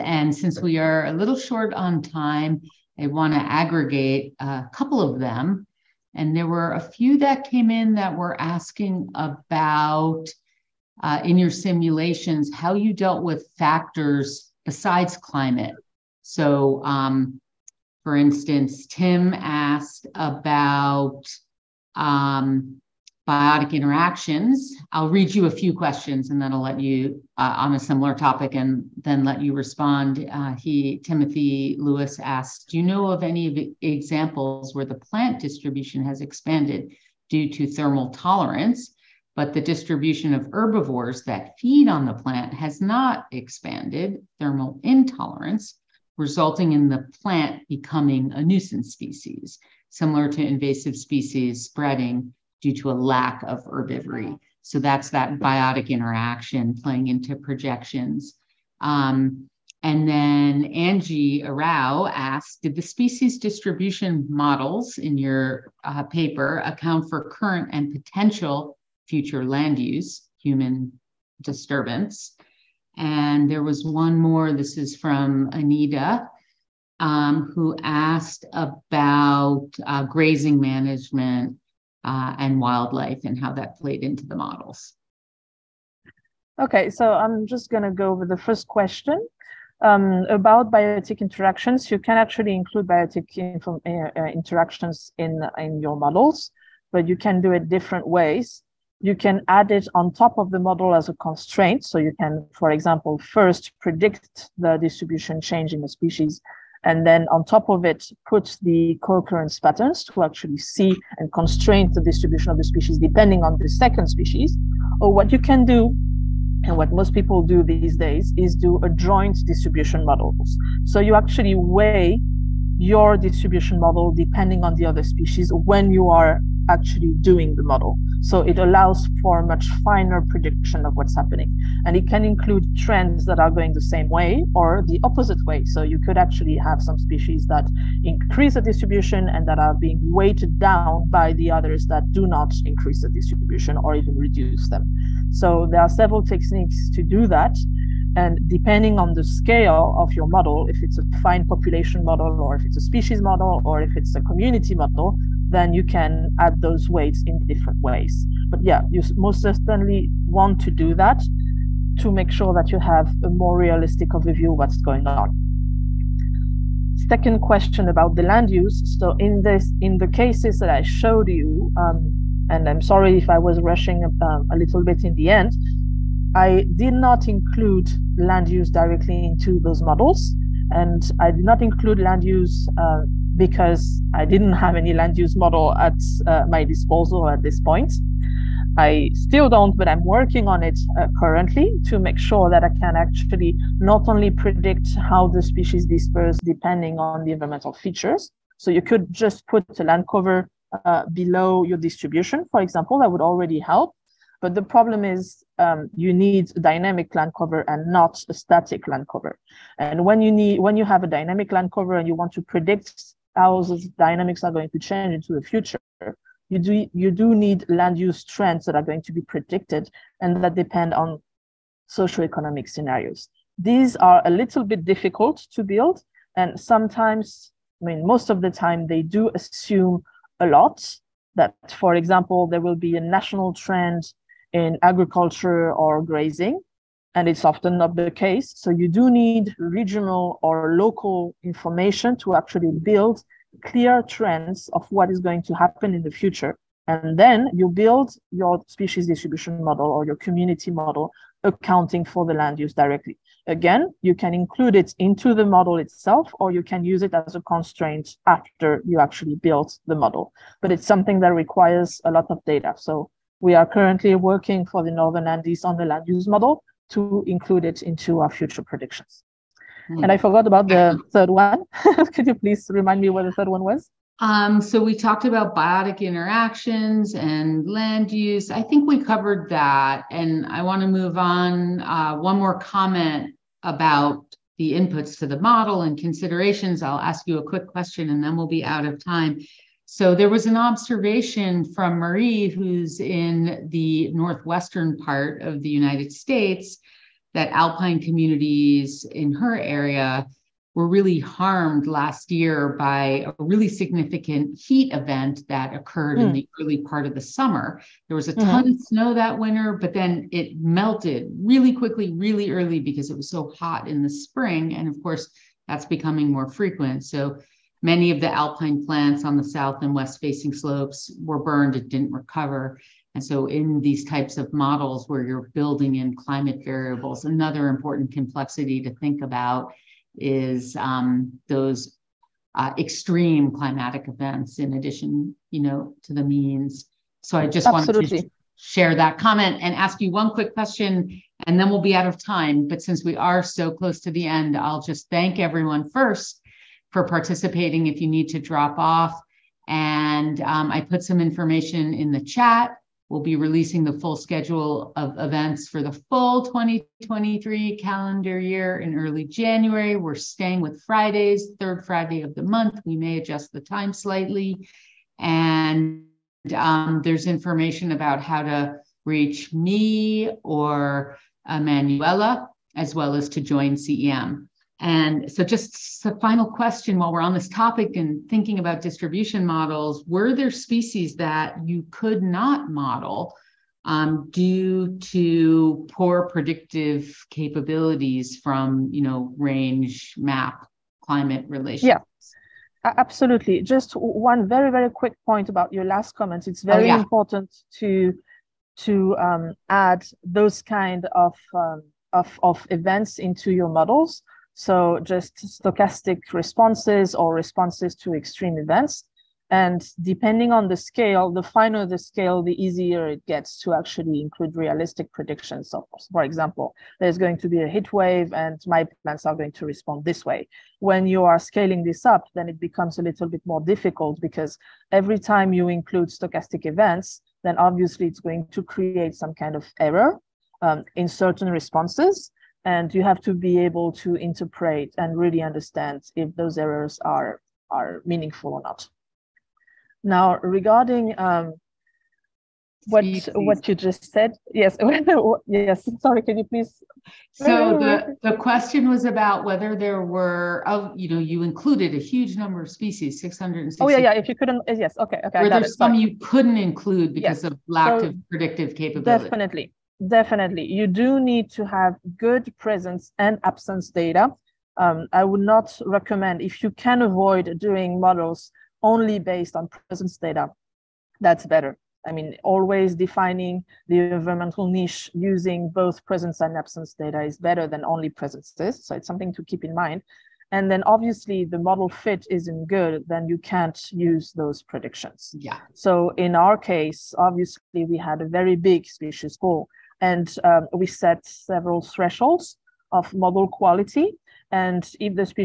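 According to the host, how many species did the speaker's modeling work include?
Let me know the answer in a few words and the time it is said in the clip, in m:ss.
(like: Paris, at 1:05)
660, at 7:33.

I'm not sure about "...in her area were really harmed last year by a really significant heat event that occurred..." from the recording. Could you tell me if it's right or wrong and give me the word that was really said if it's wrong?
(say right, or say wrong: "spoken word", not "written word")
right.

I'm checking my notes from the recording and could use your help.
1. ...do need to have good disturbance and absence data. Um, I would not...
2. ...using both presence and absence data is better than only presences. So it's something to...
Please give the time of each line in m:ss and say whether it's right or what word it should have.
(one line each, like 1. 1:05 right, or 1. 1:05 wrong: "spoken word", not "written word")
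1. 7:40 wrong: "presence", not "disturbance"
2. 7:55 right.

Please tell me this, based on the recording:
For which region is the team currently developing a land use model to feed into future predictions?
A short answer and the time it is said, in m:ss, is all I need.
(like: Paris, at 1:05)
Northern Andes, at 4:24.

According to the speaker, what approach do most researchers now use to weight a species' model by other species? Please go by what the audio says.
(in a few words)
joint distribution models.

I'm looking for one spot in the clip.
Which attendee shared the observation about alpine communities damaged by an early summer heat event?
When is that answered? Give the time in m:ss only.
4:51.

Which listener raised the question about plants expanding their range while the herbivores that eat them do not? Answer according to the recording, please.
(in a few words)
Timothy Lewis.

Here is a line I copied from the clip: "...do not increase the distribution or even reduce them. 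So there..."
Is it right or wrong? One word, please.
right.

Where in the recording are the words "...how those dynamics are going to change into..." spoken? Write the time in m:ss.
3:33.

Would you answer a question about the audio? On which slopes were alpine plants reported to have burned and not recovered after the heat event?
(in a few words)
south and west facing.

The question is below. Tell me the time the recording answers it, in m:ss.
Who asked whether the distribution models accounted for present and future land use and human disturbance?
1:00.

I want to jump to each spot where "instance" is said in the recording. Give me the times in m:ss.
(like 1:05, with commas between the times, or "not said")
0:18.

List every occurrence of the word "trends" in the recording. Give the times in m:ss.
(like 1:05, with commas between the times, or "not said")
2:12, 3:38, 3:53, 4:04.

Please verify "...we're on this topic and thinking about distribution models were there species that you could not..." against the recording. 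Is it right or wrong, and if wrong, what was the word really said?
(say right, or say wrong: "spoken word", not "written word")
right.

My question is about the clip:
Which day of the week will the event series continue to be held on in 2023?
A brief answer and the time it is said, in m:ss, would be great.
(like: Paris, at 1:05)
Fridays, at 6:00.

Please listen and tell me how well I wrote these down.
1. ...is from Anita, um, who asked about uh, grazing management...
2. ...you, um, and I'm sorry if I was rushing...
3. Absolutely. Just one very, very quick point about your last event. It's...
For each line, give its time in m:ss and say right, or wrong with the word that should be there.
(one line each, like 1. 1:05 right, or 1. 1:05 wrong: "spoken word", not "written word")
1. 1:14 right
2. 2:51 right
3. 6:32 wrong: "comment", not "event".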